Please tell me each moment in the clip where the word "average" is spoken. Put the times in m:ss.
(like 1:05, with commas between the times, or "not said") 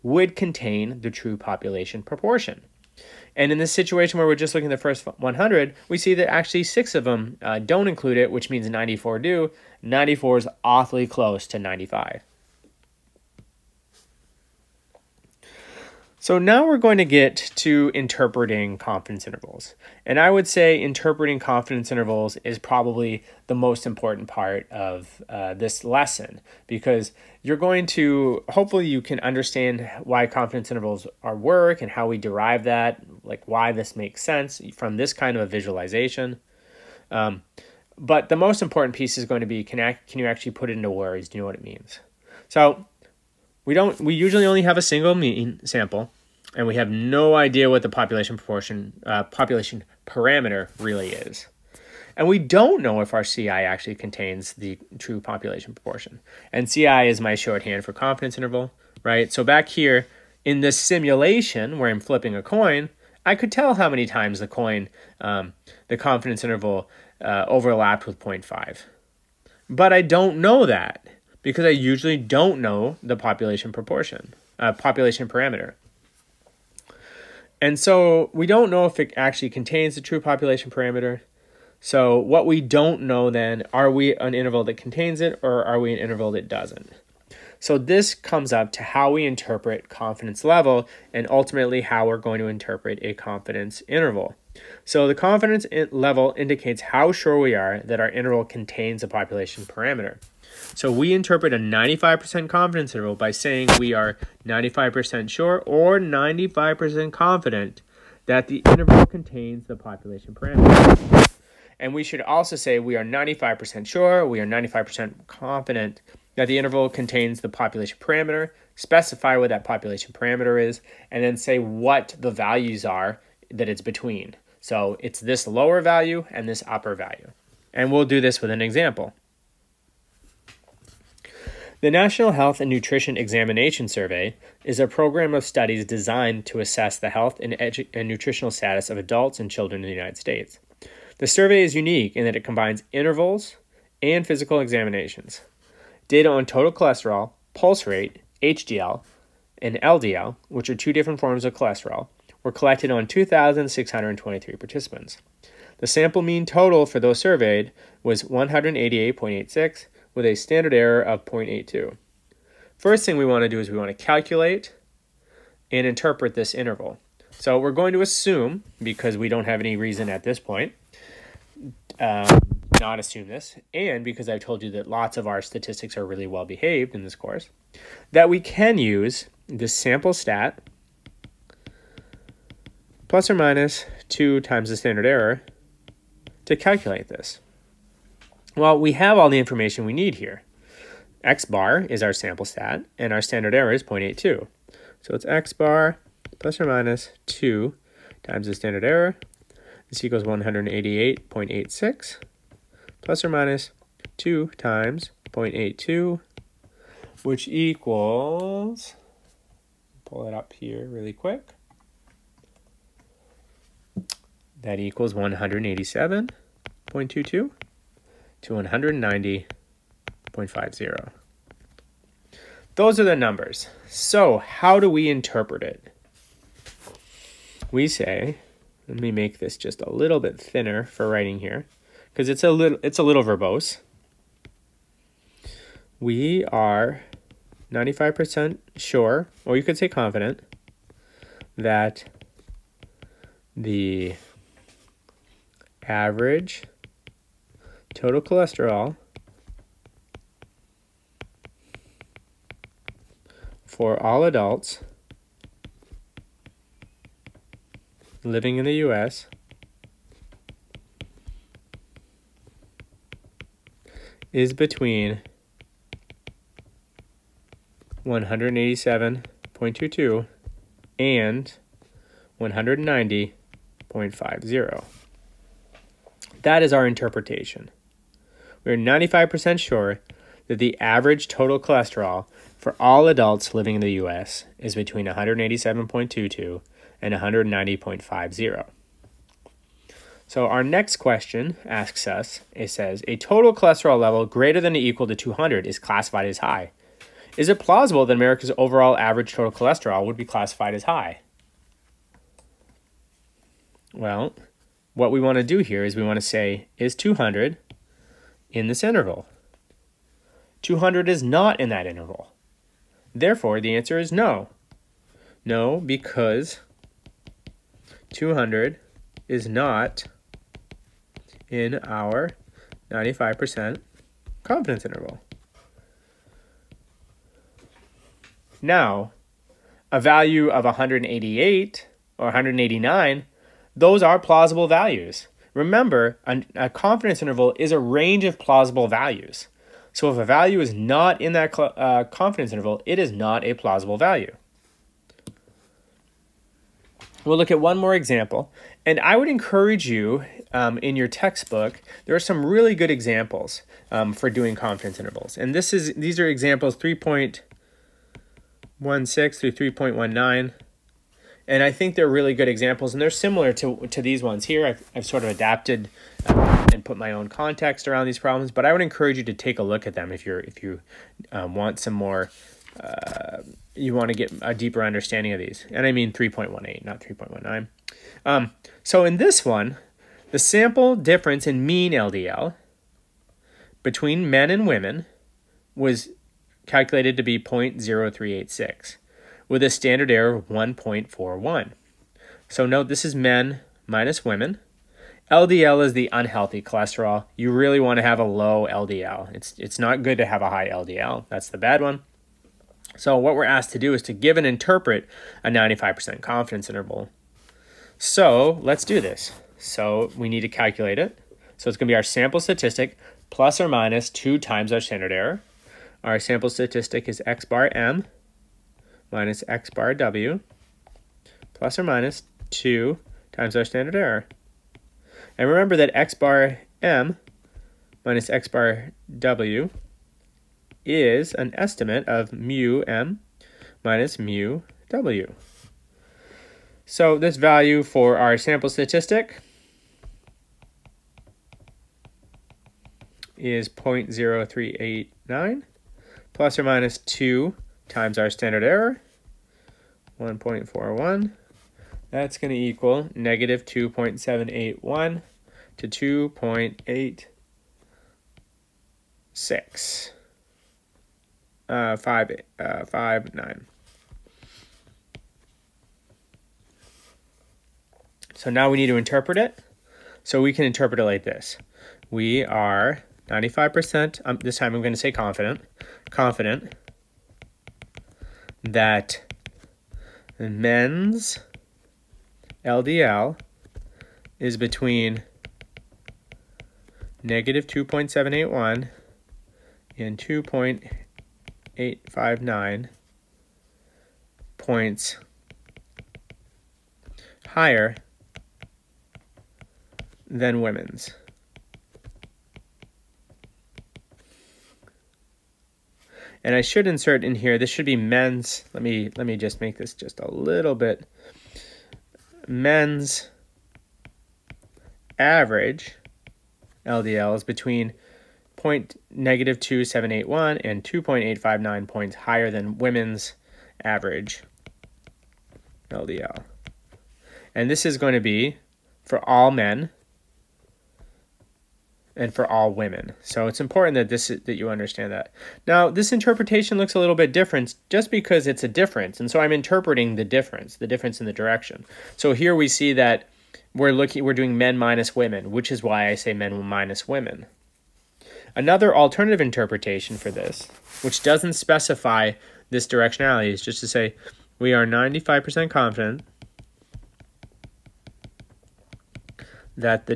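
4:05, 4:40, 4:58, 8:35, 8:43.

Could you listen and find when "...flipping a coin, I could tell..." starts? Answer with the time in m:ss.
1:01.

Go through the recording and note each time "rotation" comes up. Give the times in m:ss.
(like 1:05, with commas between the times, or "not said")
not said.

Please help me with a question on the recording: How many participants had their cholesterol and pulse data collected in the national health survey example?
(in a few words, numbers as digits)
2,623.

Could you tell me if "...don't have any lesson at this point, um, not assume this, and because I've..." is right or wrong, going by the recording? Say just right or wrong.
wrong.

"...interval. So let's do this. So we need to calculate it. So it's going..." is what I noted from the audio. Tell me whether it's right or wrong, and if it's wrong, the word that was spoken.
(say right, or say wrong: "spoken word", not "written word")
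right.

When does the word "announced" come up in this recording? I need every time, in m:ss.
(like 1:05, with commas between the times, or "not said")
not said.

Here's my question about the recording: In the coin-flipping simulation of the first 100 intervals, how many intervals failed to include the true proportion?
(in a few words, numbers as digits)
6.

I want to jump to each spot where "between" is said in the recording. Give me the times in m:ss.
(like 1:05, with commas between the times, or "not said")
2:03, 4:24, 4:44, 6:23, 8:04, 8:37.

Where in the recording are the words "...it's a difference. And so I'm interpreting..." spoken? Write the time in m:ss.
8:58.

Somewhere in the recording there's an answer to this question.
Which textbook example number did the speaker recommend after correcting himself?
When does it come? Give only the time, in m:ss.
6:16.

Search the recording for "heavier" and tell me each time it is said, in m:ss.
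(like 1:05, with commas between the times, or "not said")
not said.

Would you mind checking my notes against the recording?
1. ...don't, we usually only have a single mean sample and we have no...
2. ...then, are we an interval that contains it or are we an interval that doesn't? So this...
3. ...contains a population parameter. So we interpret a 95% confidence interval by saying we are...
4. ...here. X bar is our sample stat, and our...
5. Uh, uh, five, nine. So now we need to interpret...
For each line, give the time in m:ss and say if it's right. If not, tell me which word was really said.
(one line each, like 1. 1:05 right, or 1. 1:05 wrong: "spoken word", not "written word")
1. 0:43 right
2. 1:23 right
3. 1:38 right
4. 3:10 right
5. 7:41 right.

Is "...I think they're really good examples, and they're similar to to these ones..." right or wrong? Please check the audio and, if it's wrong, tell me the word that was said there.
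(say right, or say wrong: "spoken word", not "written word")
right.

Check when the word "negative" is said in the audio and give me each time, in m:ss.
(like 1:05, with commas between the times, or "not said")
7:33, 8:07, 8:39.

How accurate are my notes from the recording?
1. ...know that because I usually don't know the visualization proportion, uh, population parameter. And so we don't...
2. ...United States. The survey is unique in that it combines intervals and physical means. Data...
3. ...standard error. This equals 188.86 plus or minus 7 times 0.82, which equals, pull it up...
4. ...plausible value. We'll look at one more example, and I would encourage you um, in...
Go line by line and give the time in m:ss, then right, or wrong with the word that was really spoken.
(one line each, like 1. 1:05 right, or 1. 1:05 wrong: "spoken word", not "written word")
1. 1:10 wrong: "population", not "visualization"
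2. 2:19 wrong: "examinations", not "means"
3. 3:18 wrong: "2", not "7"
4. 5:43 right.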